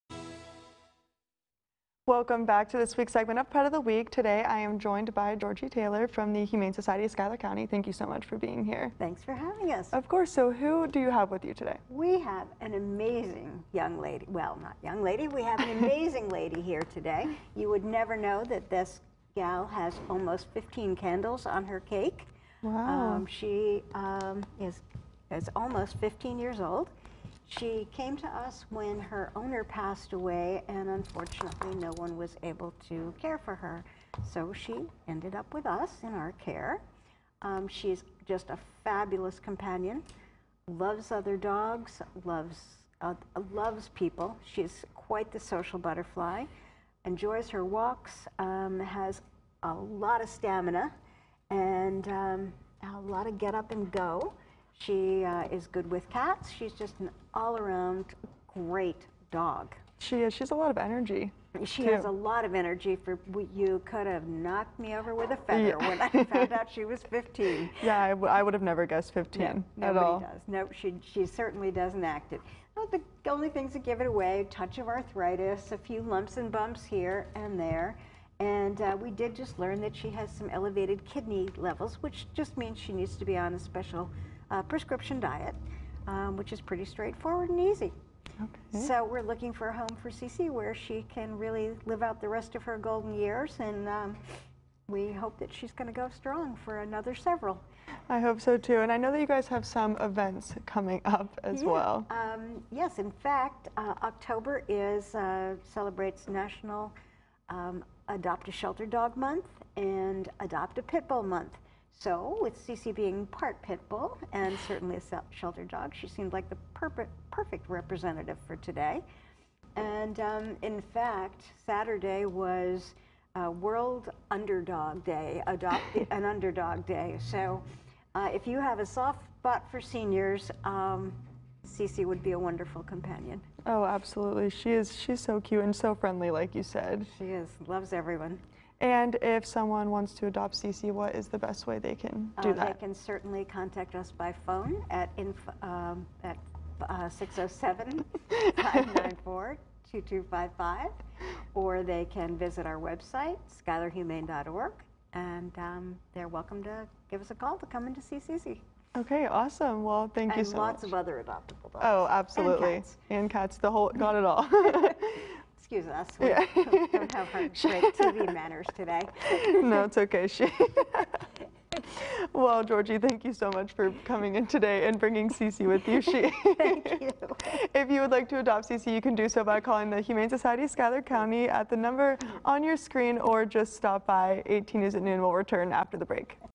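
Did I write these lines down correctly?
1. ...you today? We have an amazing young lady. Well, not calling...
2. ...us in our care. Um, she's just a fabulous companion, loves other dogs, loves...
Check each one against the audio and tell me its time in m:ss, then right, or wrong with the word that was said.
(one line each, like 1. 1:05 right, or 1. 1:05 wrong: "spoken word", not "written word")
1. 0:11 wrong: "young", not "calling"
2. 0:35 right.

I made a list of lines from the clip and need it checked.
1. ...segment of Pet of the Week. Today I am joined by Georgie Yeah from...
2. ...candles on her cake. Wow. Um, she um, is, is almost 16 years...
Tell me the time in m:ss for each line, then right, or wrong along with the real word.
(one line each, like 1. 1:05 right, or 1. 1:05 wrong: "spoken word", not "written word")
1. 0:03 wrong: "Taylor", not "Yeah"
2. 0:20 wrong: "15", not "16".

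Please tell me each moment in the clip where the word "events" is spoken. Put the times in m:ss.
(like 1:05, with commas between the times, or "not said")
1:40.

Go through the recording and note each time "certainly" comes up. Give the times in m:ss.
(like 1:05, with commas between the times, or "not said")
1:11, 1:54, 2:22.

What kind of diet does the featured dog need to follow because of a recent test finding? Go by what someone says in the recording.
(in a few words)
prescription diet.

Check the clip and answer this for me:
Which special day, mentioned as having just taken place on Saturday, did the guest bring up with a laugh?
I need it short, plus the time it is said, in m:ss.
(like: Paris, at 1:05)
World Underdog Day, at 2:03.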